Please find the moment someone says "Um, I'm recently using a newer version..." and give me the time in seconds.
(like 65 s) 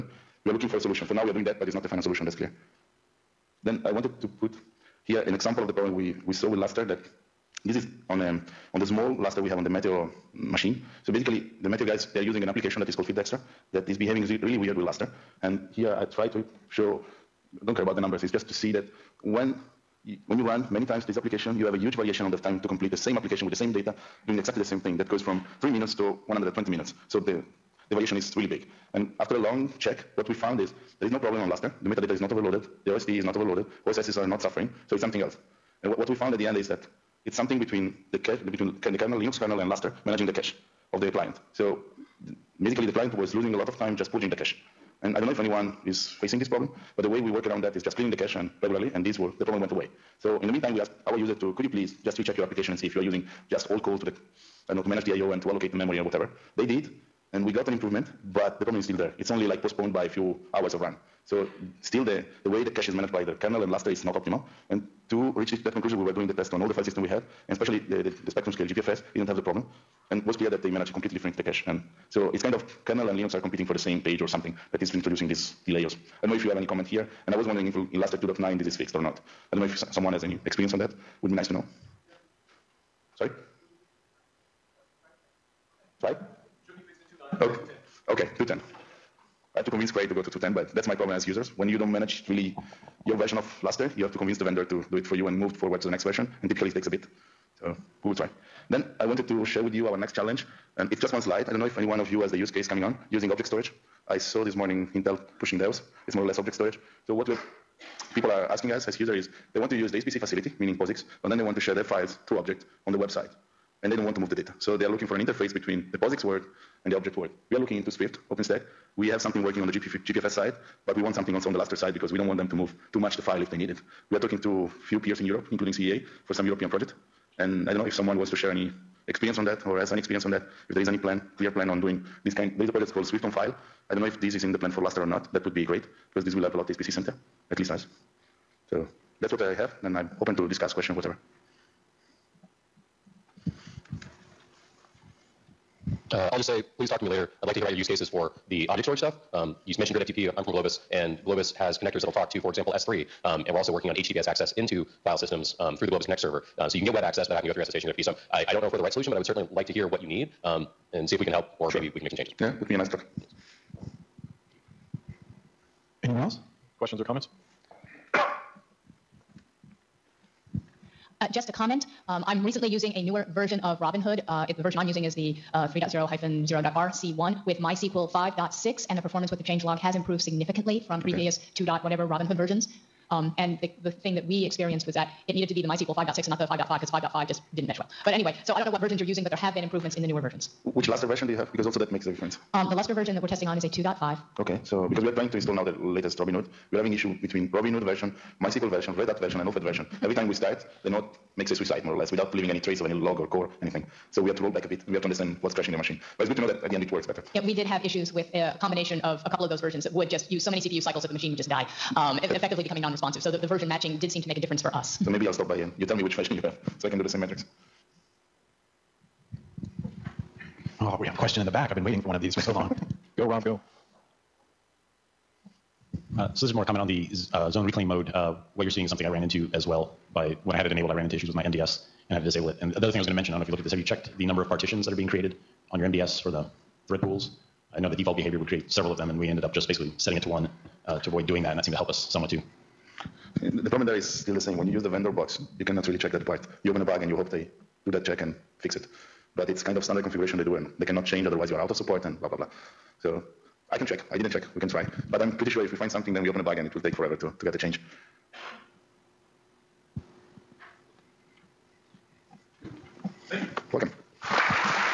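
172 s.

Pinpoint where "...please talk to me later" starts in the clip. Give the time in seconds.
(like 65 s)
146 s.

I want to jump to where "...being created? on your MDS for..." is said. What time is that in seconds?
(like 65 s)
234 s.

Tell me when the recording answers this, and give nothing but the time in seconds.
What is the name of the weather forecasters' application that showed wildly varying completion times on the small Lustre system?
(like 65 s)
13 s.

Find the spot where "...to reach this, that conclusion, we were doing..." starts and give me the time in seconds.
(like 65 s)
65 s.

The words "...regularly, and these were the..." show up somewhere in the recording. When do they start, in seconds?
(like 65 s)
48 s.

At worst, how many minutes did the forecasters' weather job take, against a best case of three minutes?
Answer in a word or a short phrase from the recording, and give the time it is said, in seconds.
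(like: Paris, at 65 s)
120, at 26 s.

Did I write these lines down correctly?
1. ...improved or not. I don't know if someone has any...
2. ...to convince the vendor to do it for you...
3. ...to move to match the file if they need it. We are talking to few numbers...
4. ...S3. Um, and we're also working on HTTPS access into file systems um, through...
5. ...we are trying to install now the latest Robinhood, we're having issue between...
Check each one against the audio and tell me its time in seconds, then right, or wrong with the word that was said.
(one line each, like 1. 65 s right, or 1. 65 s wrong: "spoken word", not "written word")
1. 78 s wrong: "fixed", not "improved"
2. 94 s right
3. 122 s wrong: "peers", not "numbers"
4. 152 s right
5. 195 s right.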